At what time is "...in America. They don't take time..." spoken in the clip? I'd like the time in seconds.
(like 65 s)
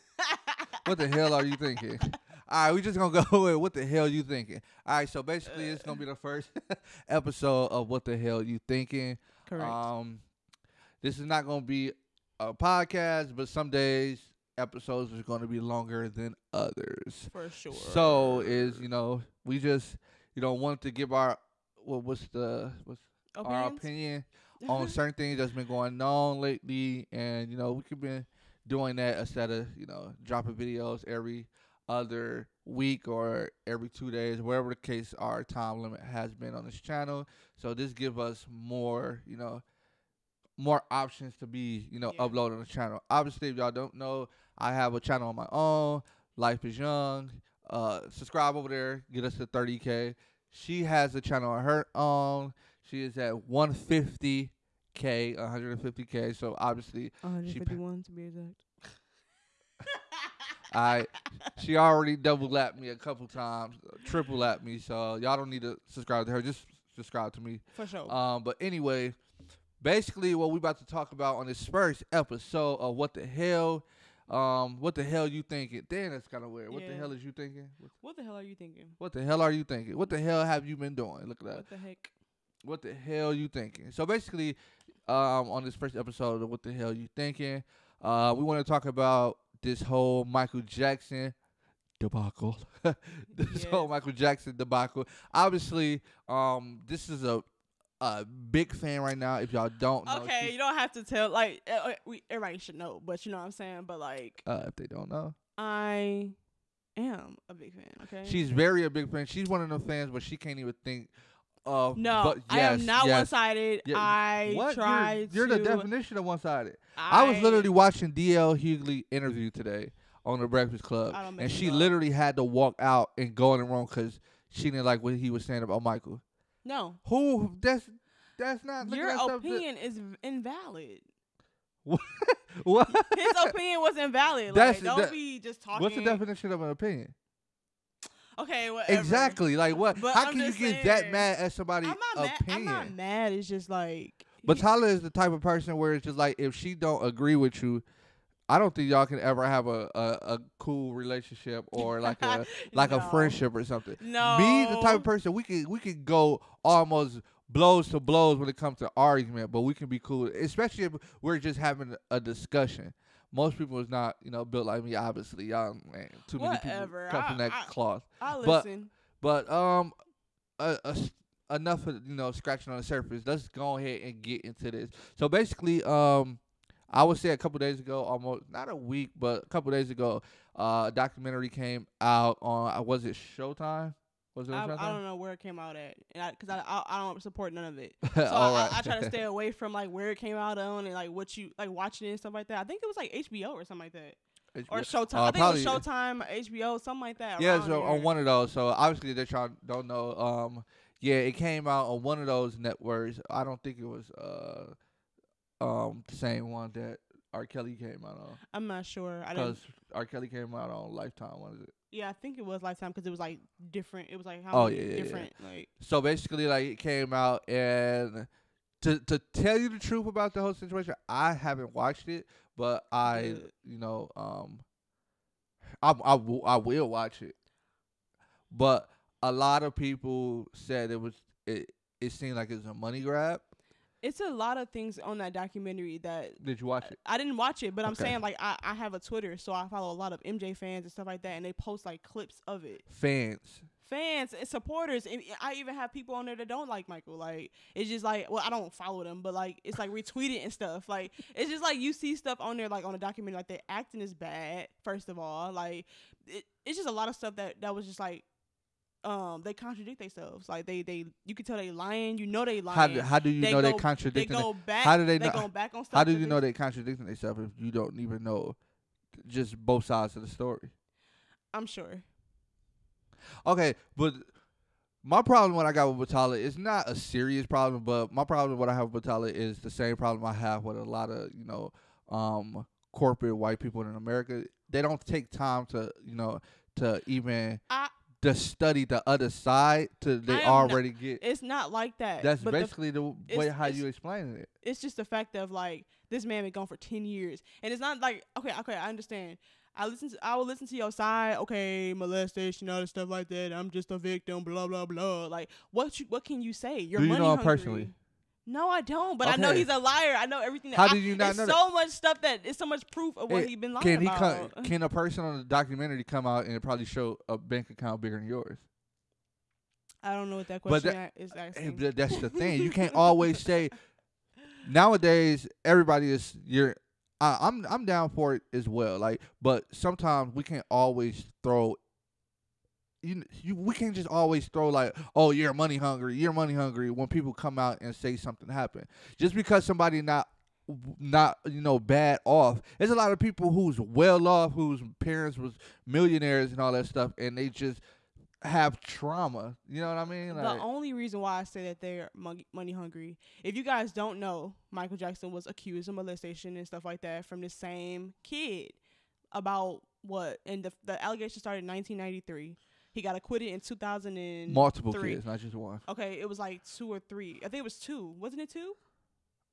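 283 s.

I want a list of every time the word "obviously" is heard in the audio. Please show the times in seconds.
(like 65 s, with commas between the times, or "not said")
43 s, 56 s, 95 s, 164 s, 198 s.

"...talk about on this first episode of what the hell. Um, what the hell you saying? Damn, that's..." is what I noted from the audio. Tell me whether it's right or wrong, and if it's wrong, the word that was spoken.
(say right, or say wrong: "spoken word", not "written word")
wrong: "thinking", not "saying".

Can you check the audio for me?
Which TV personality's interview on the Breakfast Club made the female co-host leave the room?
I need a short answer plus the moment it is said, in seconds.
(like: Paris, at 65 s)
DL Hughley, at 118 s.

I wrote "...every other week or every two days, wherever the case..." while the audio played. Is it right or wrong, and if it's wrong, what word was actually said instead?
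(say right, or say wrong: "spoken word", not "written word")
right.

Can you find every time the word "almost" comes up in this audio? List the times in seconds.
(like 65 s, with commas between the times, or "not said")
156 s, 178 s.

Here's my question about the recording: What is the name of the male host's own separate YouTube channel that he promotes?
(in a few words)
Life is young.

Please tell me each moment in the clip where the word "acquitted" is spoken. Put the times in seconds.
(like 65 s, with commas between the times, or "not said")
363 s.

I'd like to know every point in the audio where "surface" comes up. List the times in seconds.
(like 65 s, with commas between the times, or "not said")
172 s.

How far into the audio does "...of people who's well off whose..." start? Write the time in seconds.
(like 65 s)
343 s.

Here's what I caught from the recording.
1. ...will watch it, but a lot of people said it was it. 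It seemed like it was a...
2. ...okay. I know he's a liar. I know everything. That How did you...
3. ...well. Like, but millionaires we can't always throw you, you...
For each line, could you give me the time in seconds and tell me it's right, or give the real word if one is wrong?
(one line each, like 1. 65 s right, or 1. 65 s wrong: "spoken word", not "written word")
1. 226 s right
2. 309 s right
3. 328 s wrong: "sometimes", not "millionaires".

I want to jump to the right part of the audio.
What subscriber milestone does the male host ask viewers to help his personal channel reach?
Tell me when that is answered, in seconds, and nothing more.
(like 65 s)
49 s.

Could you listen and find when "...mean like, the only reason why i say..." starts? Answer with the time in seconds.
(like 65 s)
350 s.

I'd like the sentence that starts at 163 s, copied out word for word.
Most people is not you know built like me.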